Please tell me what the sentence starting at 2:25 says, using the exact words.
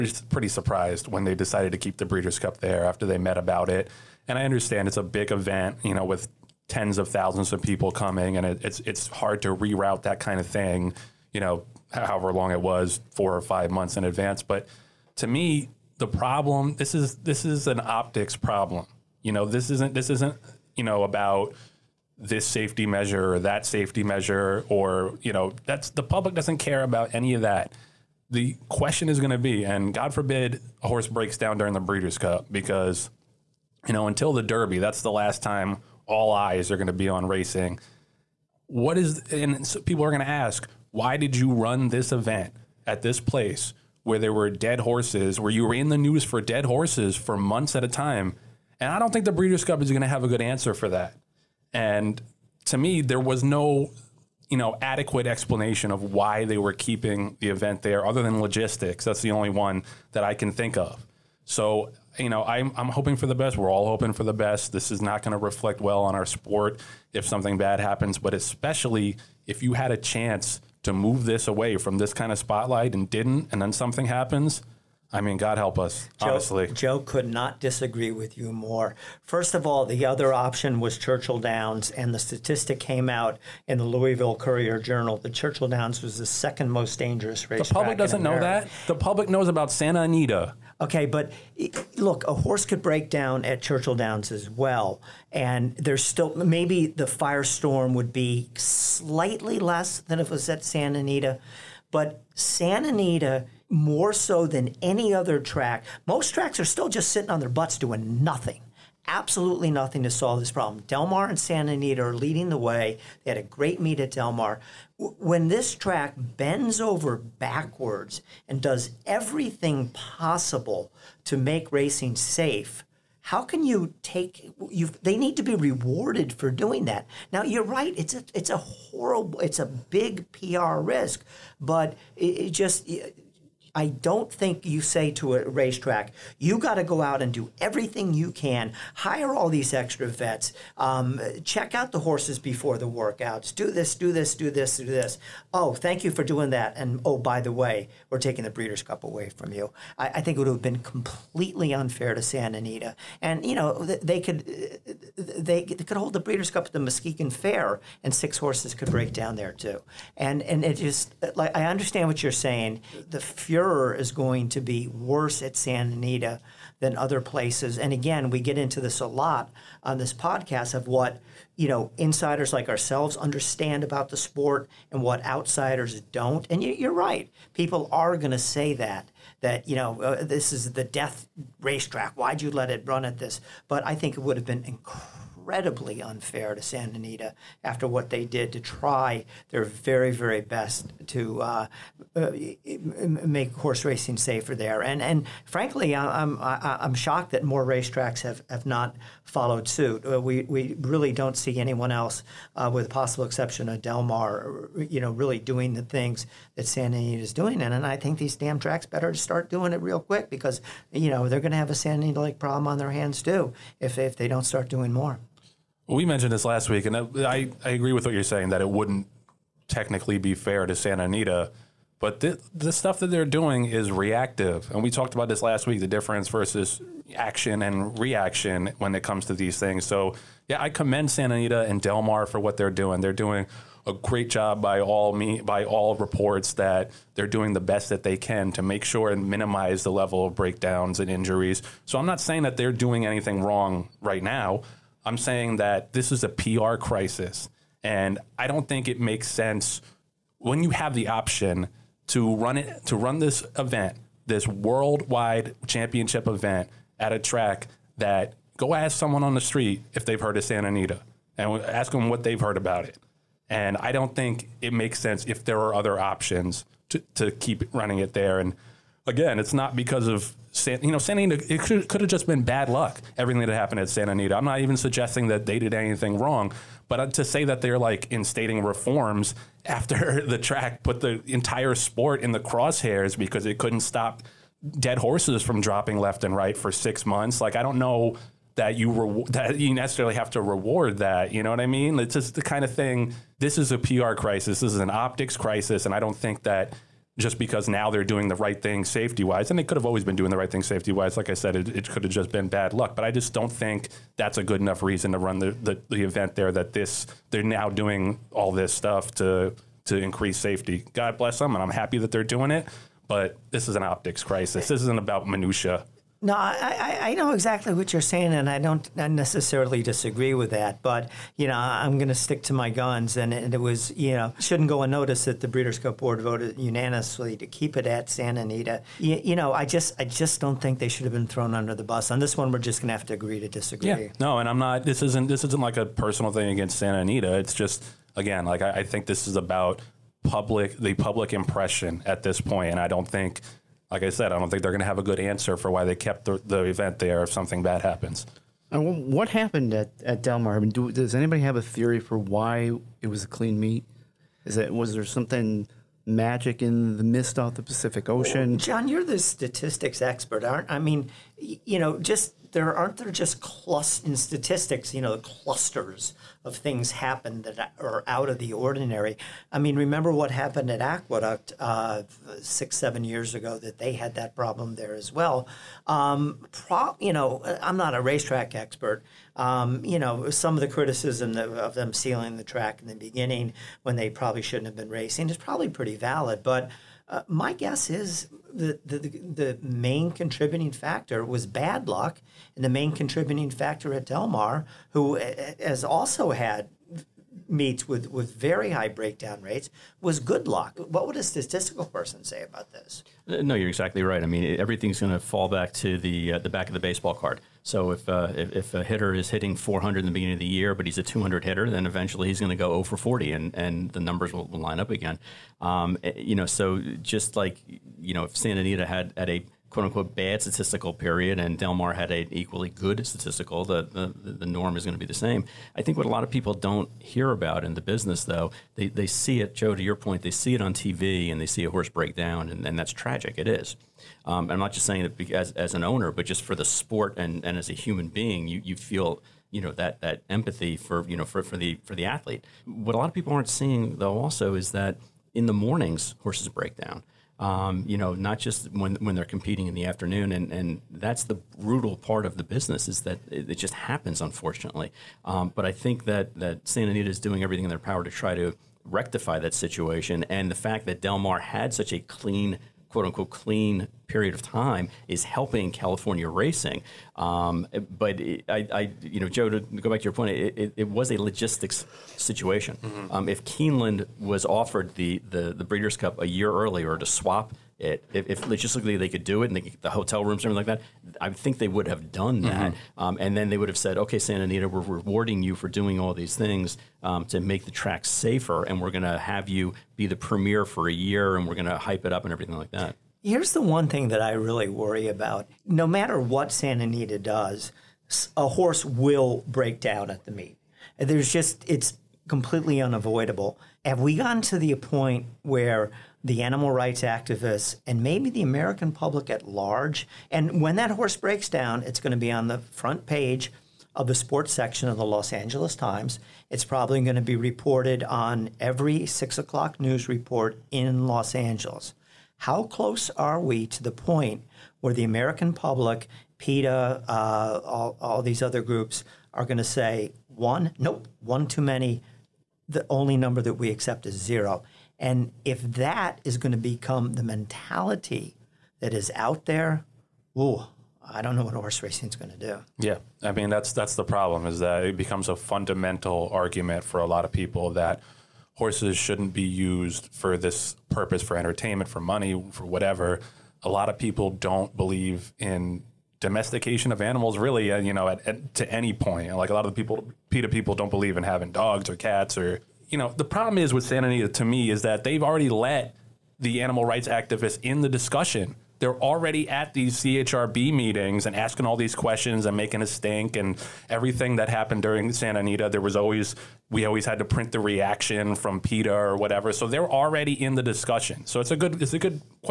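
Oh, thank you for doing that.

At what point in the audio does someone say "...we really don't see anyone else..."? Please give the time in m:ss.
3:20.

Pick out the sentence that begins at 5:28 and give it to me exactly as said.
You, you know, I just I just don't think they should have been thrown under the bus.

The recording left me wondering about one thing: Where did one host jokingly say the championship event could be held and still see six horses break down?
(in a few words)
Muskegon Fair.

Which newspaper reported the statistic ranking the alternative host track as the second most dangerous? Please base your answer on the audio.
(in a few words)
Louisville Courier Journal.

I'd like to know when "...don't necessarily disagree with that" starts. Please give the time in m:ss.
5:18.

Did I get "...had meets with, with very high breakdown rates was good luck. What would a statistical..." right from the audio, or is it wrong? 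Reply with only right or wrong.
right.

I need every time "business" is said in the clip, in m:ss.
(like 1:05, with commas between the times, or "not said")
7:07, 7:32.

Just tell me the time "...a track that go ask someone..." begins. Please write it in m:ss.
4:17.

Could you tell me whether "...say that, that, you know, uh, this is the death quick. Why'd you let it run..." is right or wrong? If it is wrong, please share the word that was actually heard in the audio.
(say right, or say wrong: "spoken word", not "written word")
wrong: "racetrack", not "quick".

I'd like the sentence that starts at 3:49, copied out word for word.
So, yeah, I commend Santa Anita and Del Mar for what they're doing.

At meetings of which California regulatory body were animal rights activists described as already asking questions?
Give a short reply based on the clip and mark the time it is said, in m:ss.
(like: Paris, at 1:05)
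CHRB, at 9:29.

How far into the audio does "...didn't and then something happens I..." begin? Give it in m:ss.
1:13.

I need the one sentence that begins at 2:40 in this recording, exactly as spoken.
And, and it just, like, I understand what you're saying.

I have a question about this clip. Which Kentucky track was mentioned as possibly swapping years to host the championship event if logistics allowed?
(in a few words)
Keeneland.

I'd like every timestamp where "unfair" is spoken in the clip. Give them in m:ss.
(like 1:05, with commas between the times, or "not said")
2:31, 3:06.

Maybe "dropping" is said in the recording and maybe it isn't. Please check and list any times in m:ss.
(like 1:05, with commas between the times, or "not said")
4:45.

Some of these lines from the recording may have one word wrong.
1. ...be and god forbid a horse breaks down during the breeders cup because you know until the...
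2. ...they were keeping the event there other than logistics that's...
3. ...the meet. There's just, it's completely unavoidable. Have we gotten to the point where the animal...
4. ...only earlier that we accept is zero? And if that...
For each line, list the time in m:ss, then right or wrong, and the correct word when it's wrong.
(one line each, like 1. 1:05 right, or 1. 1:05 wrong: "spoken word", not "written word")
1. 0:29 right
2. 0:56 right
3. 8:20 right
4. 8:52 wrong: "number", not "earlier".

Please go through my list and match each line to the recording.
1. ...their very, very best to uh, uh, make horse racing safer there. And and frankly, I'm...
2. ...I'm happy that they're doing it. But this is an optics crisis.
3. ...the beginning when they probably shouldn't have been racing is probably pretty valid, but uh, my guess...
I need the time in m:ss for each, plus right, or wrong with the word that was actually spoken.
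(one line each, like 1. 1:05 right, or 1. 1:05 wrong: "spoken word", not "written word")
1. 3:09 right
2. 5:11 right
3. 6:22 right.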